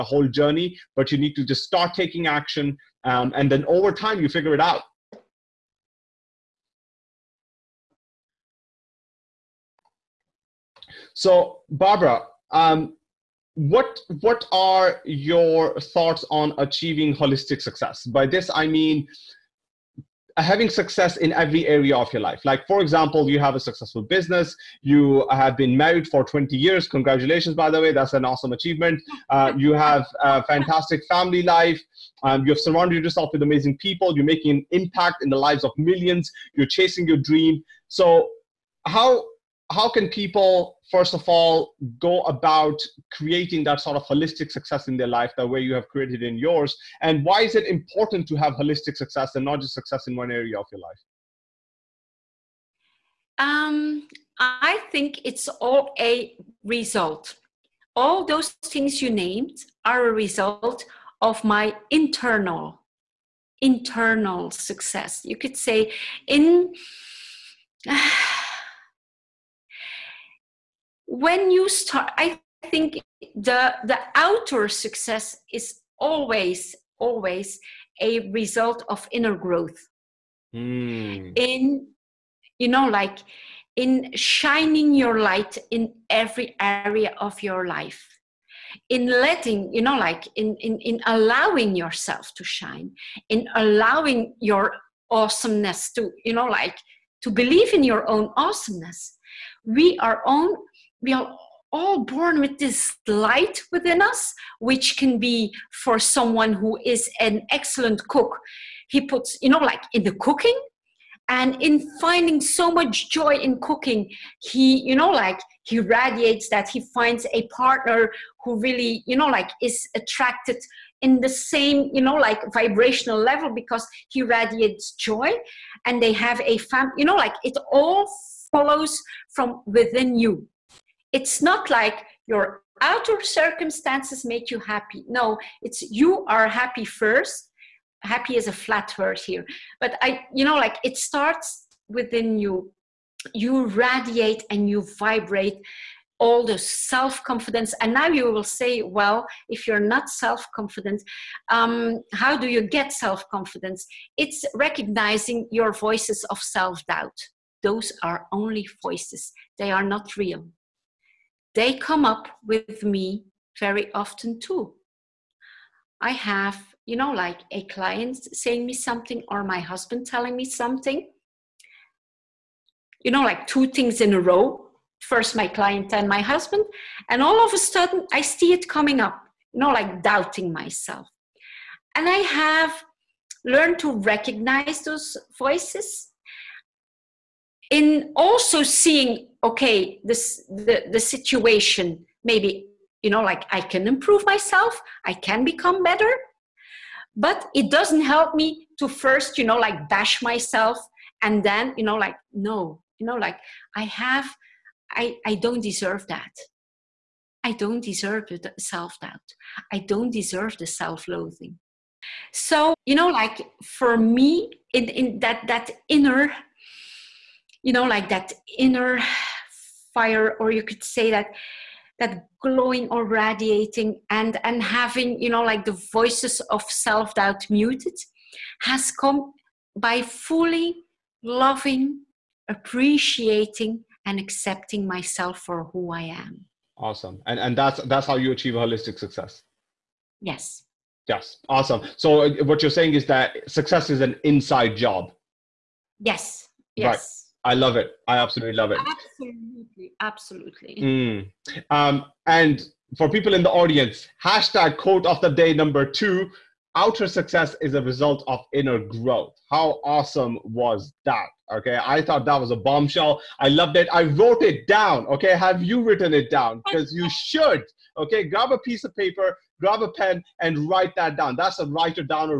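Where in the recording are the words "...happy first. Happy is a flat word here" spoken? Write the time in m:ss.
2:16.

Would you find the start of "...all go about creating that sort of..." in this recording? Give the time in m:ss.
0:41.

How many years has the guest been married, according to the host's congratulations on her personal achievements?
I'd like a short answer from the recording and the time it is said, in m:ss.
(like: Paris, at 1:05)
20, at 0:26.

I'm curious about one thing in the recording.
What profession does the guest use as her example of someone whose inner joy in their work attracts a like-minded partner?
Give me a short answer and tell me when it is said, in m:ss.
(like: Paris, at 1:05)
Cook, at 1:48.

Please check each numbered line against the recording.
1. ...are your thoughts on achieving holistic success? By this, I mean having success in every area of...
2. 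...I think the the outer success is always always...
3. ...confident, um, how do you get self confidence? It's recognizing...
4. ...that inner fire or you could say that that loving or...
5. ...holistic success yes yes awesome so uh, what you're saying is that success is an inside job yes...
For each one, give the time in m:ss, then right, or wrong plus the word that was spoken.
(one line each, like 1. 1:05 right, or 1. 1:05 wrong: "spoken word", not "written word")
1. 0:14 right
2. 1:12 right
3. 2:30 right
4. 3:38 wrong: "glowing", not "loving"
5. 3:58 right.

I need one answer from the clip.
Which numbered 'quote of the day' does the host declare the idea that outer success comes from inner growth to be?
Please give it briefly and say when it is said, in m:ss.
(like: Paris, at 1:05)
2, at 4:15.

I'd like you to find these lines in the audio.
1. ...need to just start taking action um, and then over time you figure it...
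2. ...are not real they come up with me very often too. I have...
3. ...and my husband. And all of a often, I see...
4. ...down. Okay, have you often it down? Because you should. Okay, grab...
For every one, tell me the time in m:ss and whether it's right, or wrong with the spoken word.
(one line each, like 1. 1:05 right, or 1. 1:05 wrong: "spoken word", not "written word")
1. 0:01 right
2. 2:39 right
3. 2:55 wrong: "sudden", not "often"
4. 4:24 wrong: "written", not "often".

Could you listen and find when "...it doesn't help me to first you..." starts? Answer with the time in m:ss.
3:17.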